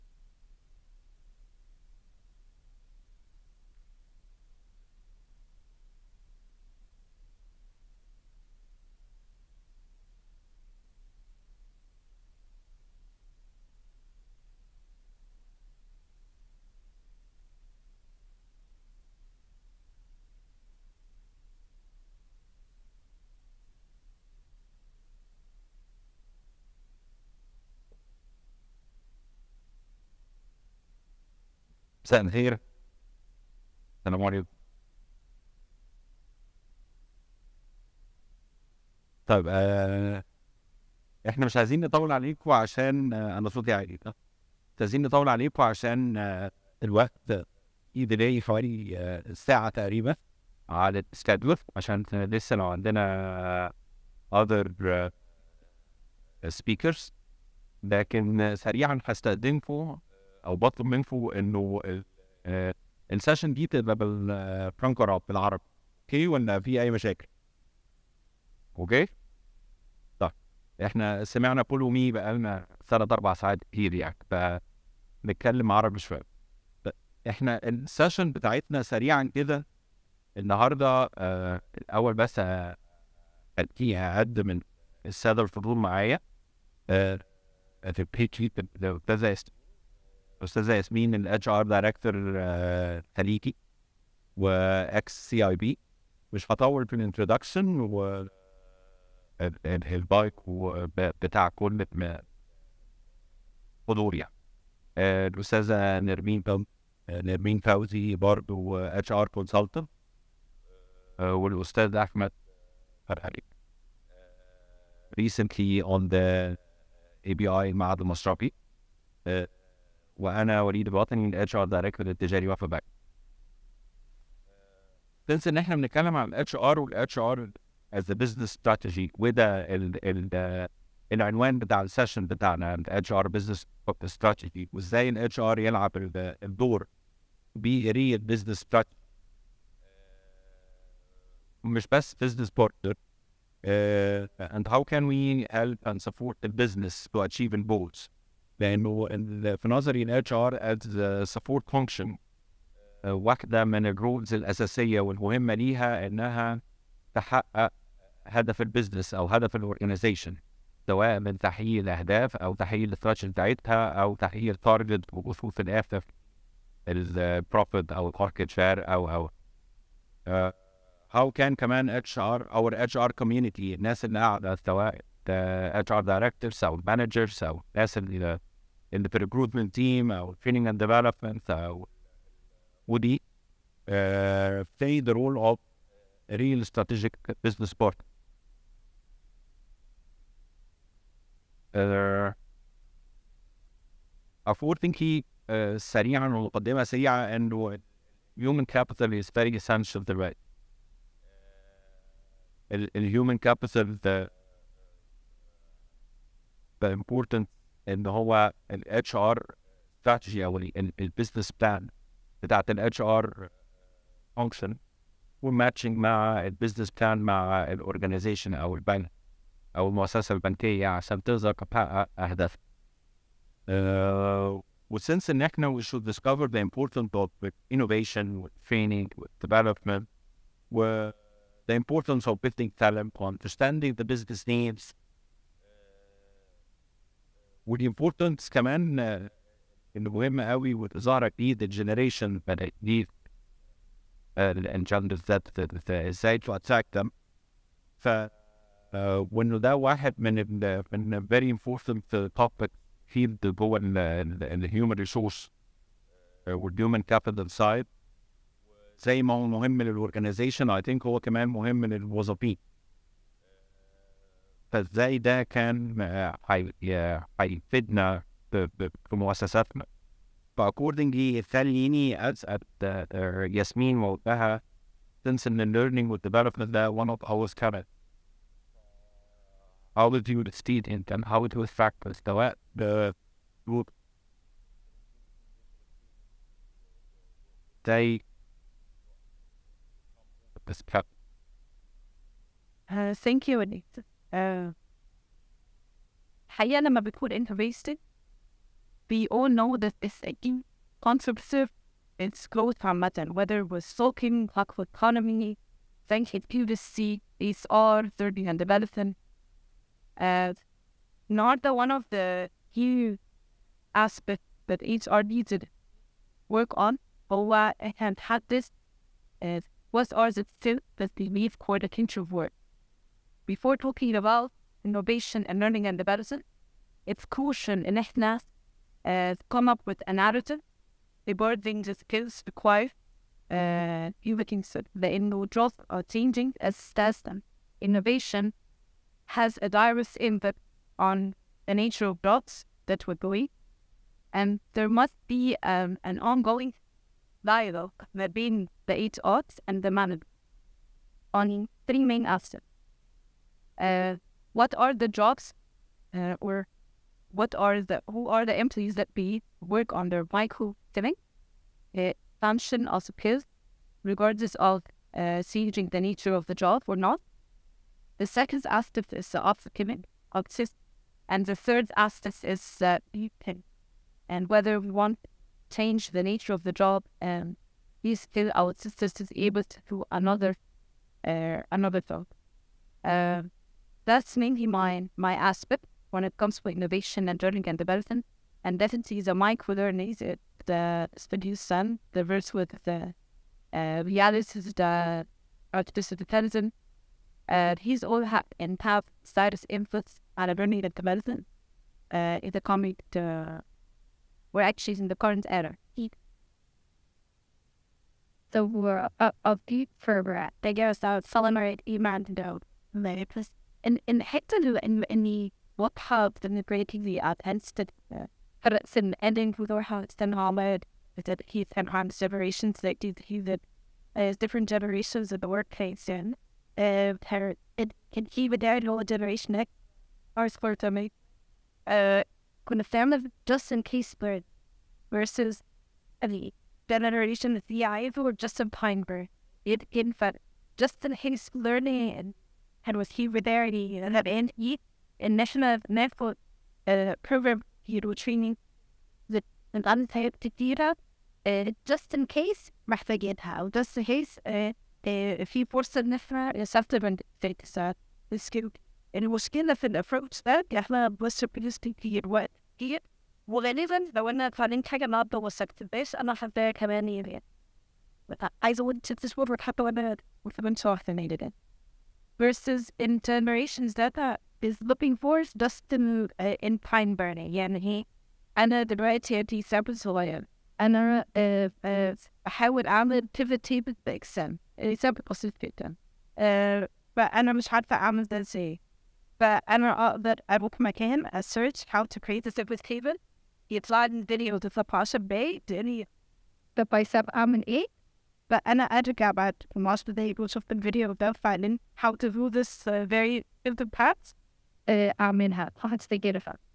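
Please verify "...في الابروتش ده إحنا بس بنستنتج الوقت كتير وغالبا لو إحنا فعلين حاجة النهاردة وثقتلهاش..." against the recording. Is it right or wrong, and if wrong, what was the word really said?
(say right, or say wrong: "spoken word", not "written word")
right.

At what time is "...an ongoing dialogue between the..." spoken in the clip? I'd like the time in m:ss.
5:46.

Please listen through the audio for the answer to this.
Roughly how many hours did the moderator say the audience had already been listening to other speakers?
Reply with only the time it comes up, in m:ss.
1:12.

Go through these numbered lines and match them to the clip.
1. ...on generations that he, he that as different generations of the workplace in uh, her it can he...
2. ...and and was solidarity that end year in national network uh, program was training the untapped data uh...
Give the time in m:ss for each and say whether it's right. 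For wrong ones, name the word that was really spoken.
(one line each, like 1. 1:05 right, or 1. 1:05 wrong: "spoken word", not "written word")
1. 7:01 right
2. 7:22 right.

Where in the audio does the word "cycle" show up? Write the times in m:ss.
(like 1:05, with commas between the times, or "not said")
not said.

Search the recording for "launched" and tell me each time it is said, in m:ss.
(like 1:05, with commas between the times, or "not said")
not said.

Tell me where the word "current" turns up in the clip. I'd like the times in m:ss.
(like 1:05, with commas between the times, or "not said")
4:37, 6:45.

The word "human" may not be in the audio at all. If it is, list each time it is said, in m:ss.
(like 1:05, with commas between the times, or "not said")
3:18, 3:22.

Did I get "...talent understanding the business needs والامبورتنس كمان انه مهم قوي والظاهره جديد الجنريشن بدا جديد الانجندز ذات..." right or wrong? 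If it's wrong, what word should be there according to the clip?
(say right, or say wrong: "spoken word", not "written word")
right.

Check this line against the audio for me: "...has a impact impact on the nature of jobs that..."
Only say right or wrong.
wrong.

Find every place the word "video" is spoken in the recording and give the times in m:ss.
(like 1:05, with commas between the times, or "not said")
8:14, 8:20.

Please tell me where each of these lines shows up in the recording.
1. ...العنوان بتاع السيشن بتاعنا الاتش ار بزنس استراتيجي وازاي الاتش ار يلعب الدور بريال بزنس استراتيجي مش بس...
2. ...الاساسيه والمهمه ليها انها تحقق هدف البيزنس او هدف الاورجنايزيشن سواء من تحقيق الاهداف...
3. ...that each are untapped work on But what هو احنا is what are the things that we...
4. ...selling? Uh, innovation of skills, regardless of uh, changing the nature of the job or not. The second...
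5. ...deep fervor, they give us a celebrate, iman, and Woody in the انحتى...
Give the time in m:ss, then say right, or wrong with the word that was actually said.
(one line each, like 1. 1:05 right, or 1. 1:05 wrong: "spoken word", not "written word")
1. 2:11 right
2. 2:34 right
3. 5:14 wrong: "needed", not "untapped"
4. 6:00 wrong: "function", not "innovation"
5. 6:49 wrong: "Merry", not "Woody".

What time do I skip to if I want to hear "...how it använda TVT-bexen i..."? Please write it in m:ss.
8:02.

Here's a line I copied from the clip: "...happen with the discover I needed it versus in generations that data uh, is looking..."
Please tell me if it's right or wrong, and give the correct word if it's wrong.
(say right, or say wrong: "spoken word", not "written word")
wrong: "winter", not "discover".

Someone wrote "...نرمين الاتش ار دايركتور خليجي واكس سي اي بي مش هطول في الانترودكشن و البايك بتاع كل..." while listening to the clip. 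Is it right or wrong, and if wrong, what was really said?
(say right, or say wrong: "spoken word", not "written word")
wrong: "ياسمين", not "نرمين".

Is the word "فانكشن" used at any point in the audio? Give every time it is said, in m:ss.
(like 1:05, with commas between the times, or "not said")
2:31, 3:34.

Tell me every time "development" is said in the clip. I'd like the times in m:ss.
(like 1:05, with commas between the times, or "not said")
3:00, 3:49, 4:36, 5:08, 5:25, 6:27, 6:40.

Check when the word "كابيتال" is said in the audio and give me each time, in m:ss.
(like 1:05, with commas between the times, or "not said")
4:17.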